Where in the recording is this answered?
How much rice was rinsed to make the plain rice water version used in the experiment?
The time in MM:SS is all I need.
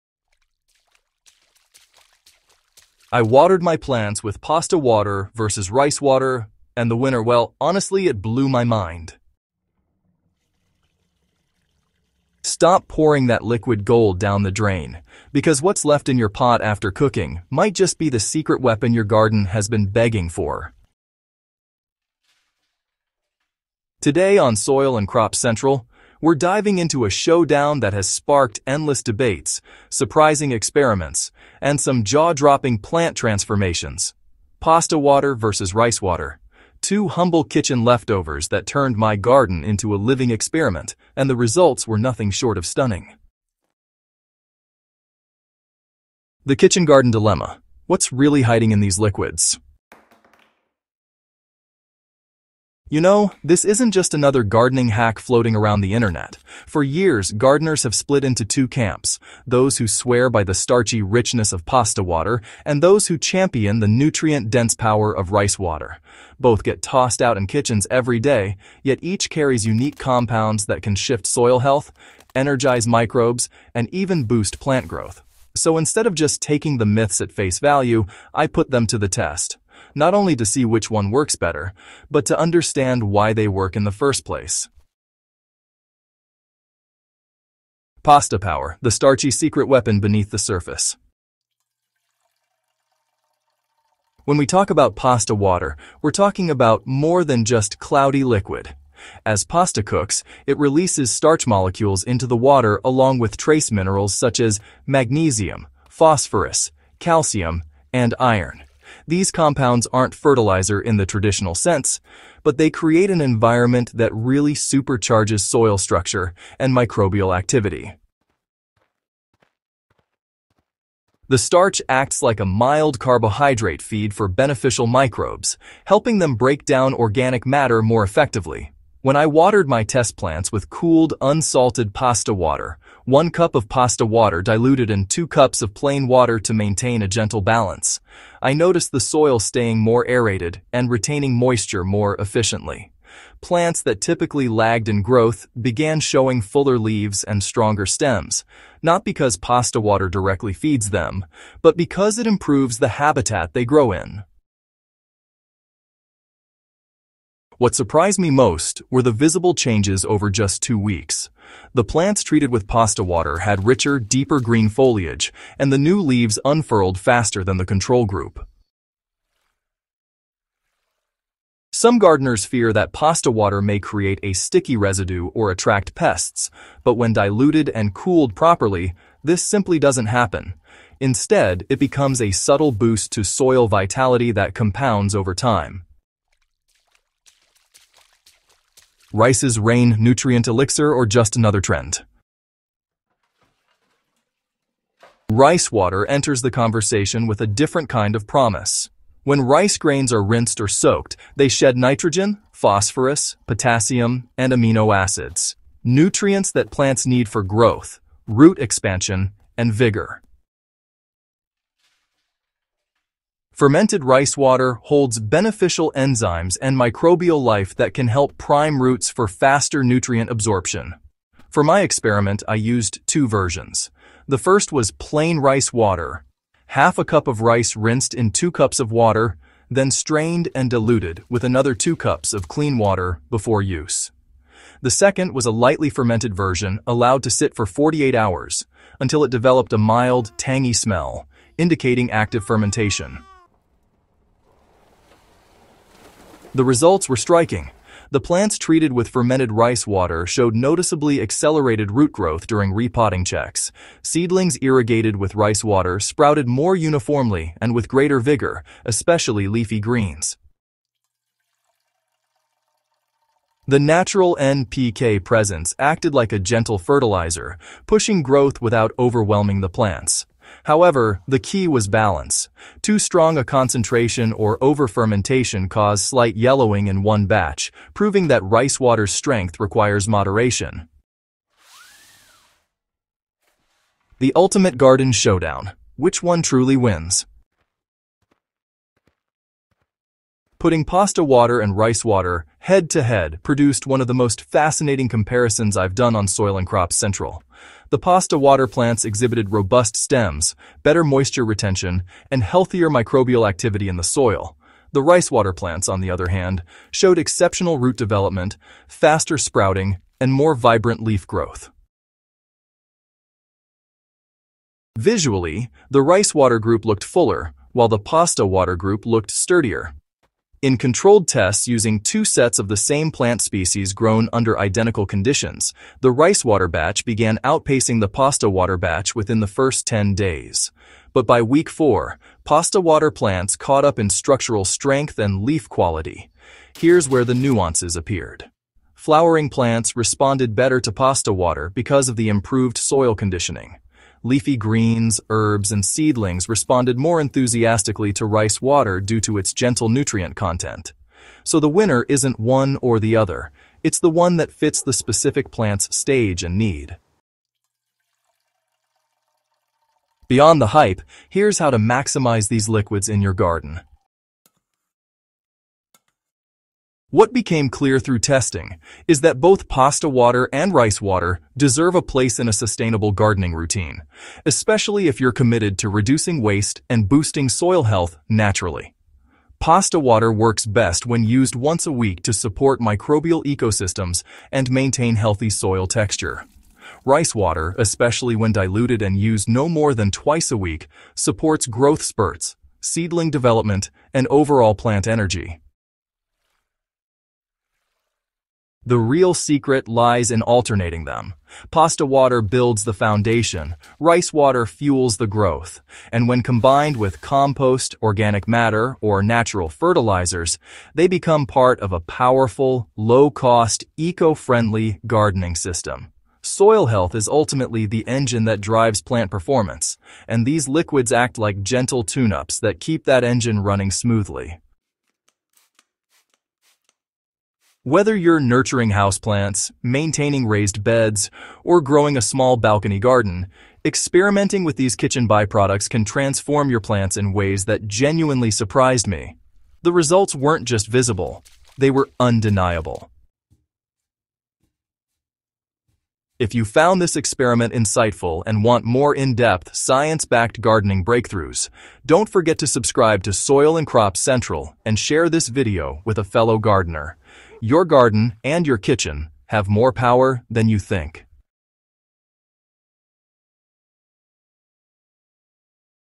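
03:46.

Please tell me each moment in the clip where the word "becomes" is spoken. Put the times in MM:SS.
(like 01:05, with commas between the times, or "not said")
03:01, 06:51.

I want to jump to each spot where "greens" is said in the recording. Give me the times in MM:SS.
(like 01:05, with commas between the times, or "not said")
02:44, 04:19, 05:44.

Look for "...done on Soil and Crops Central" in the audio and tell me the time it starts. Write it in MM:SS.
04:55.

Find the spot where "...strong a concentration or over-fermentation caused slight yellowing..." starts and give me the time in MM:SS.
04:32.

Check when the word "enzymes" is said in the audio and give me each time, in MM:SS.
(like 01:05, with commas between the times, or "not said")
03:35.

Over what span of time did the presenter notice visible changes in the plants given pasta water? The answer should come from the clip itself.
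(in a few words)
2 weeks.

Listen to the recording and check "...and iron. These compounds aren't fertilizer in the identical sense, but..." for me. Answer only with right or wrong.
wrong.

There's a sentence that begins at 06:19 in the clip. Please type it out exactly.
Pasta water works best when used once a week to support microbial ecosystems and maintain healthy soil texture.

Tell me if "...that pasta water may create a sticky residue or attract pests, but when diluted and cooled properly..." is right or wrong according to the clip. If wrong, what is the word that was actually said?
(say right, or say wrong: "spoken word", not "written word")
right.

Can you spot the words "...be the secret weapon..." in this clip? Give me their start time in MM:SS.
00:17.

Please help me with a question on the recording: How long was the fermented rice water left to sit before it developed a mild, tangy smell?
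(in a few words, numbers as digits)
48 hours.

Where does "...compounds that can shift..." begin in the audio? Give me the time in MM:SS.
01:09.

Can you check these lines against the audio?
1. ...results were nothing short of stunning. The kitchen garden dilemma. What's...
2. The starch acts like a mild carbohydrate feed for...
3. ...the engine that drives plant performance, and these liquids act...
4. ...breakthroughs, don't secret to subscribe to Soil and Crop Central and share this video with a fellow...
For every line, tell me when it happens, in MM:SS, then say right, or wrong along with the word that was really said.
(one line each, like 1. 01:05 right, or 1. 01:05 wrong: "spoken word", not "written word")
1. 00:41 right
2. 02:01 right
3. 06:57 right
4. 07:31 wrong: "forget", not "secret".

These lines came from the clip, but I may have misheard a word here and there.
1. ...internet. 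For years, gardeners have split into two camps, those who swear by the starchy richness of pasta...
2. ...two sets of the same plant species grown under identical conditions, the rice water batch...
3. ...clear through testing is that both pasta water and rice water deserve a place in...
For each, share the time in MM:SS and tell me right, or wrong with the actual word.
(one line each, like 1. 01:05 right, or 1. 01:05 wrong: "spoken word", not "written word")
1. 00:55 right
2. 05:21 right
3. 06:07 right.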